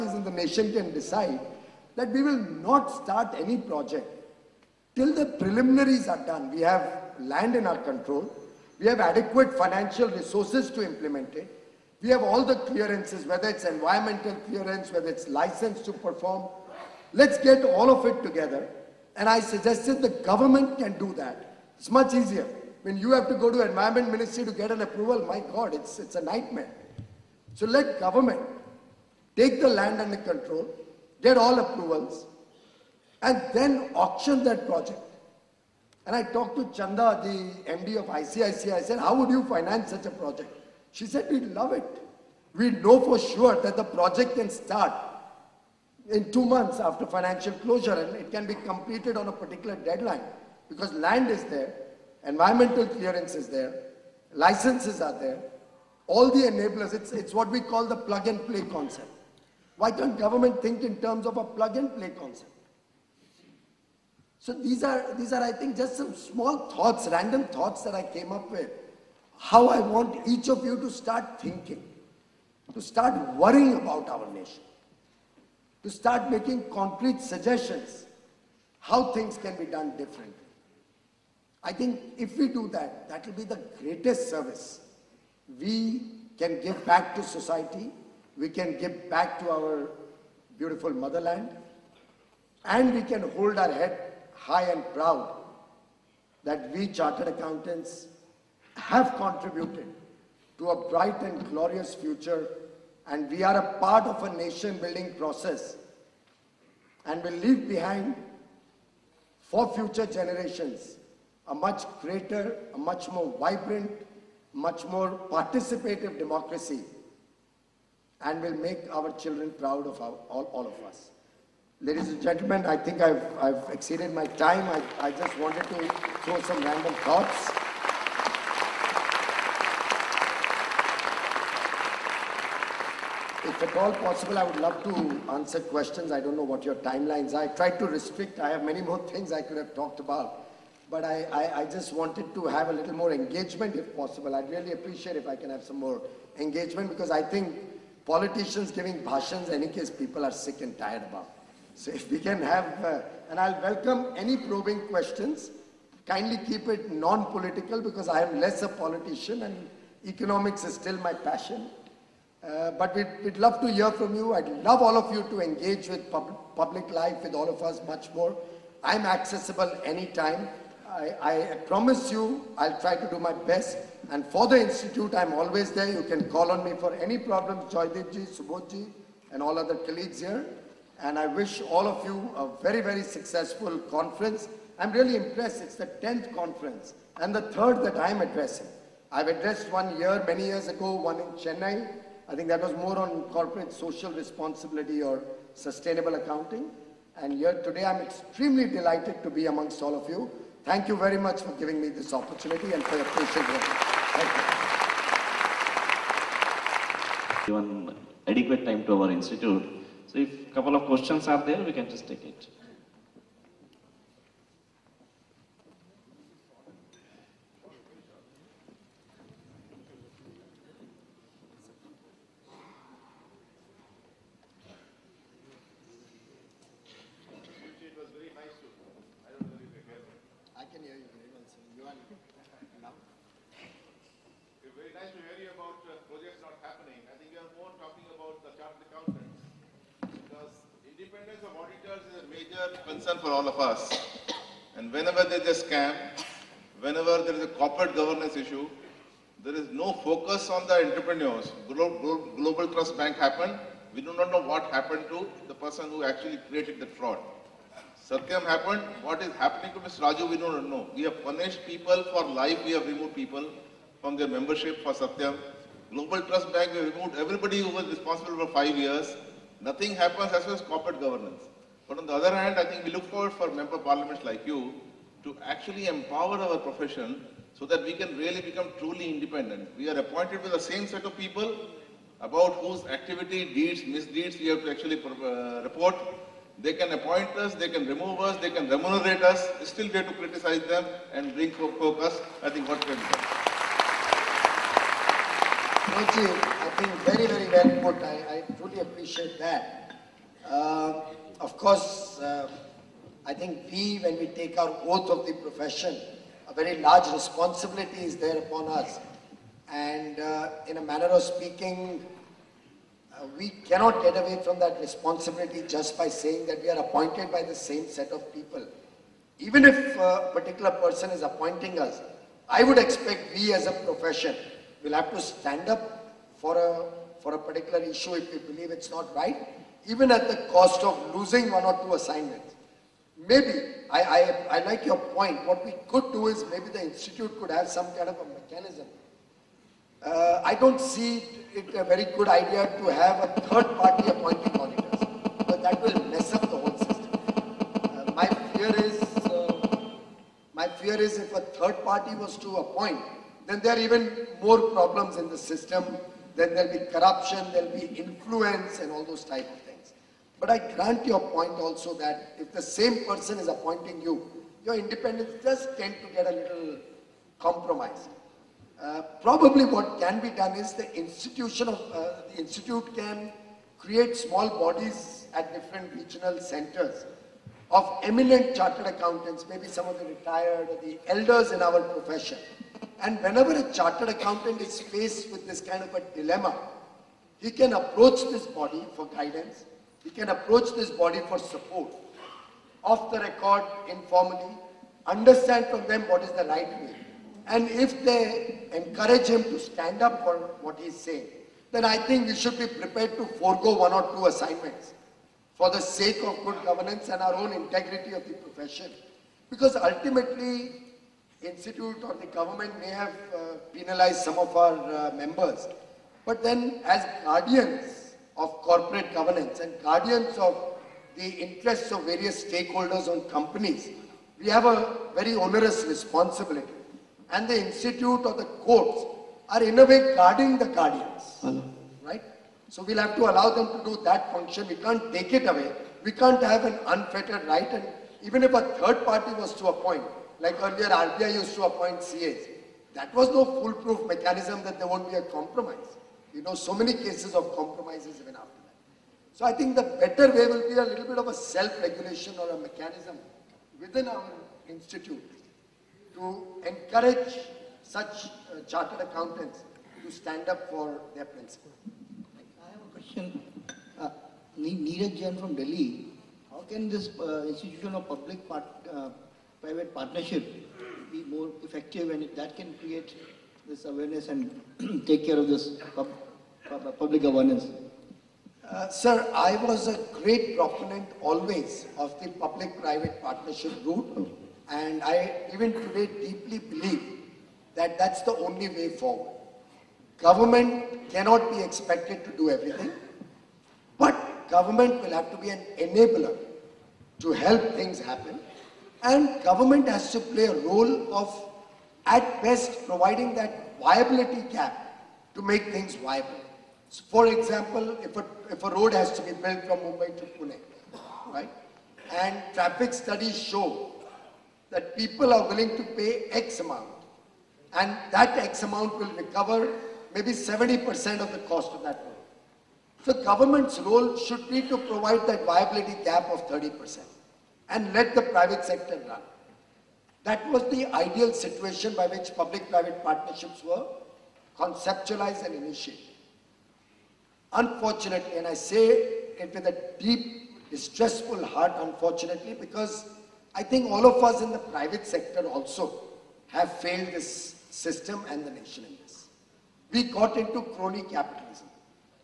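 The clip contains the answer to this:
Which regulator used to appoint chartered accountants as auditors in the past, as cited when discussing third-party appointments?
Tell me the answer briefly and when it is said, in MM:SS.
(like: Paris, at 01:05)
RBI, at 07:20.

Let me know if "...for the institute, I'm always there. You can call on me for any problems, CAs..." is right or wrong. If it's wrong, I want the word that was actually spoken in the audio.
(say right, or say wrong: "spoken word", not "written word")
wrong: "Subodh", not "CAs".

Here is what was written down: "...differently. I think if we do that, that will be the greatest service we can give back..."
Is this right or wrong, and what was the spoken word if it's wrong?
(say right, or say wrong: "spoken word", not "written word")
right.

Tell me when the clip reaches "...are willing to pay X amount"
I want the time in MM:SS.
08:35.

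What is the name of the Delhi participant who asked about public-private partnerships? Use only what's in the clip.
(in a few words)
Neeraj Jain.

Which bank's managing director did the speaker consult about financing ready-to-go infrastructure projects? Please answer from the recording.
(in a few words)
ICICI.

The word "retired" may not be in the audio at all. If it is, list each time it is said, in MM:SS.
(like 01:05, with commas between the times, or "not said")
06:20.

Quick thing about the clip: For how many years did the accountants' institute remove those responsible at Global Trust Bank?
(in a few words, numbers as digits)
5 years.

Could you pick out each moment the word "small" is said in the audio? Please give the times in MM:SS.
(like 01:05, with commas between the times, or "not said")
01:06, 06:14.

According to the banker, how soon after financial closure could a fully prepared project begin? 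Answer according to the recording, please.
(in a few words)
2 months.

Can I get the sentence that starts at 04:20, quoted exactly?
We have punished people for life.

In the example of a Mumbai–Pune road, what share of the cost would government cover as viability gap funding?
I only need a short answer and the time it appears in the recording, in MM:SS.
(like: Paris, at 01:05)
30%, at 08:46.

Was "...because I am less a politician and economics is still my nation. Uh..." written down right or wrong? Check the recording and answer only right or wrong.
wrong.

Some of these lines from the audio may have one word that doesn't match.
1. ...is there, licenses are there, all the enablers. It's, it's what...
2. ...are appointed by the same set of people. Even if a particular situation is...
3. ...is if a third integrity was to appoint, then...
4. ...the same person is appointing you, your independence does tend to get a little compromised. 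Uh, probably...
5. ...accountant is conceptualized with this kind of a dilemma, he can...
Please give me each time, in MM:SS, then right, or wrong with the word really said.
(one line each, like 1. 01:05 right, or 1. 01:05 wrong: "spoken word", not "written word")
1. 00:53 right
2. 05:16 wrong: "person", not "situation"
3. 05:51 wrong: "party", not "integrity"
4. 06:02 right
5. 06:24 wrong: "faced", not "conceptualized".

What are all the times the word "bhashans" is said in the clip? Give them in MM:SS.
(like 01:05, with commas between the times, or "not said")
02:29.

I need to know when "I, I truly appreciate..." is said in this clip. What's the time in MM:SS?
04:58.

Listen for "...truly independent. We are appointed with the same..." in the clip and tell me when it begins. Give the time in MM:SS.
04:38.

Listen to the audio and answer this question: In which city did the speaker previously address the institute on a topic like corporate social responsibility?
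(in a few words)
Chennai.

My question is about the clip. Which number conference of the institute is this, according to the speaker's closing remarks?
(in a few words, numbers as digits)
10th.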